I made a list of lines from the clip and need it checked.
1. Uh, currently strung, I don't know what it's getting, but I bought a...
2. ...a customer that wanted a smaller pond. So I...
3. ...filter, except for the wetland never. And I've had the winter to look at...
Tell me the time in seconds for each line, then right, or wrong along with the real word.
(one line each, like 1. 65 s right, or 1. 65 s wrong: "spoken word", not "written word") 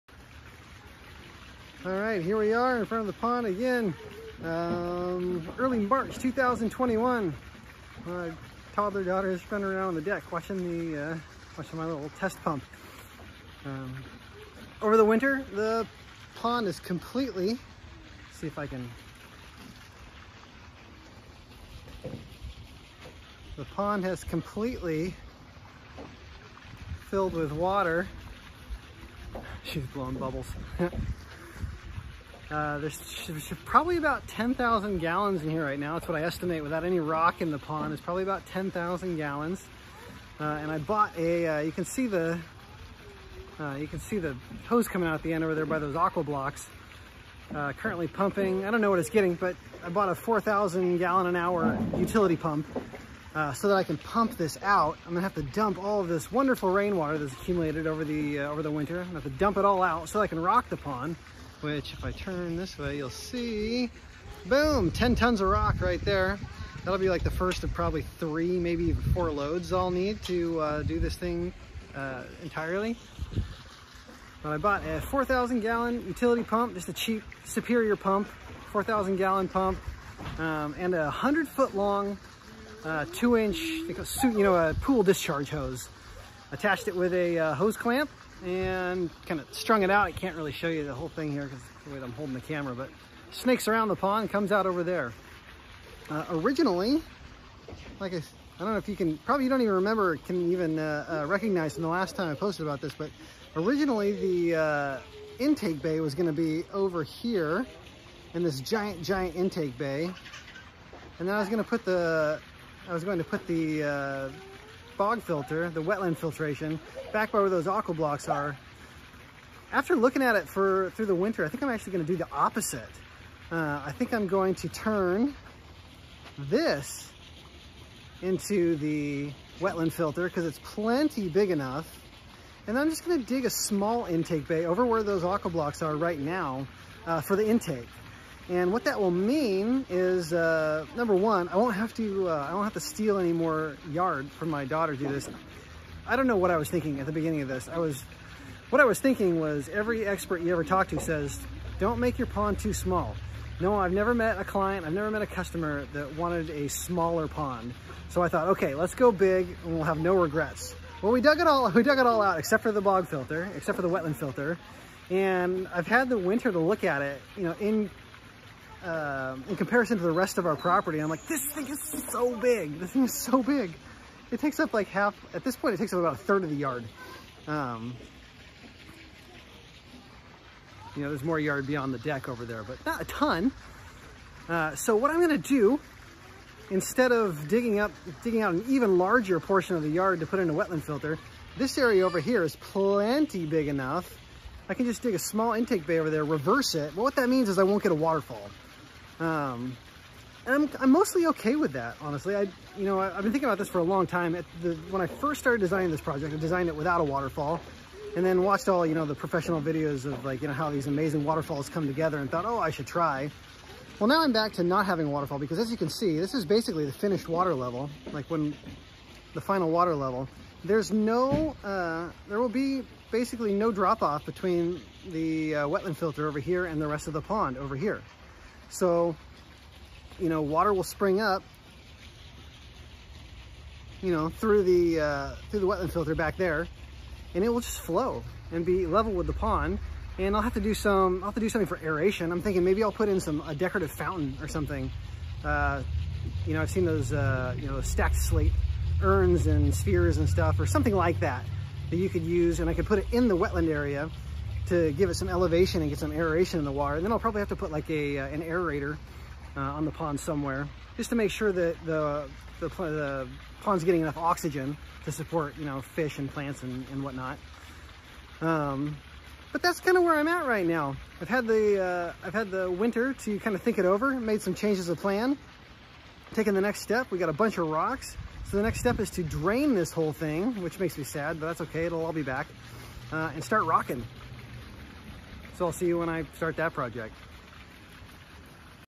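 1. 47 s wrong: "pumping", not "strung"
2. 155 s right
3. 163 s wrong: "filter", not "never".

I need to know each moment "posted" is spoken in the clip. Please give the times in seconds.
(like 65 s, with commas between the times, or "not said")
102 s.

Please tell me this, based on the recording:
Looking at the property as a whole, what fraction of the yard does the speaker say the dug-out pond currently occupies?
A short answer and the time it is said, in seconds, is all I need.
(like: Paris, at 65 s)
a third, at 176 s.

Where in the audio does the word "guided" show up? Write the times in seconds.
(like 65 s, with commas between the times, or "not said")
not said.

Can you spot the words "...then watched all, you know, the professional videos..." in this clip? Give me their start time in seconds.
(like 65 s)
208 s.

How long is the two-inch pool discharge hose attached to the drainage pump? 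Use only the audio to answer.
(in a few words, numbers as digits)
100 feet.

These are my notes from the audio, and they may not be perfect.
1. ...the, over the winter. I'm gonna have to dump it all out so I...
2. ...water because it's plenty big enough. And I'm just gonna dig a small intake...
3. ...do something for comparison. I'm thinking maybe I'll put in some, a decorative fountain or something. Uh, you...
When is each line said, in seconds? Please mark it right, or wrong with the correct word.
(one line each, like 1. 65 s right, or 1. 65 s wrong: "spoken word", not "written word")
1. 58 s right
2. 129 s wrong: "filter", not "water"
3. 241 s wrong: "aeration", not "comparison".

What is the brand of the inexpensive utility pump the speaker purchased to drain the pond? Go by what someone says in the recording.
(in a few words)
Superior.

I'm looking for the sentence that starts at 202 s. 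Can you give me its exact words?
I, you know, I, have been thinking about this for a long time.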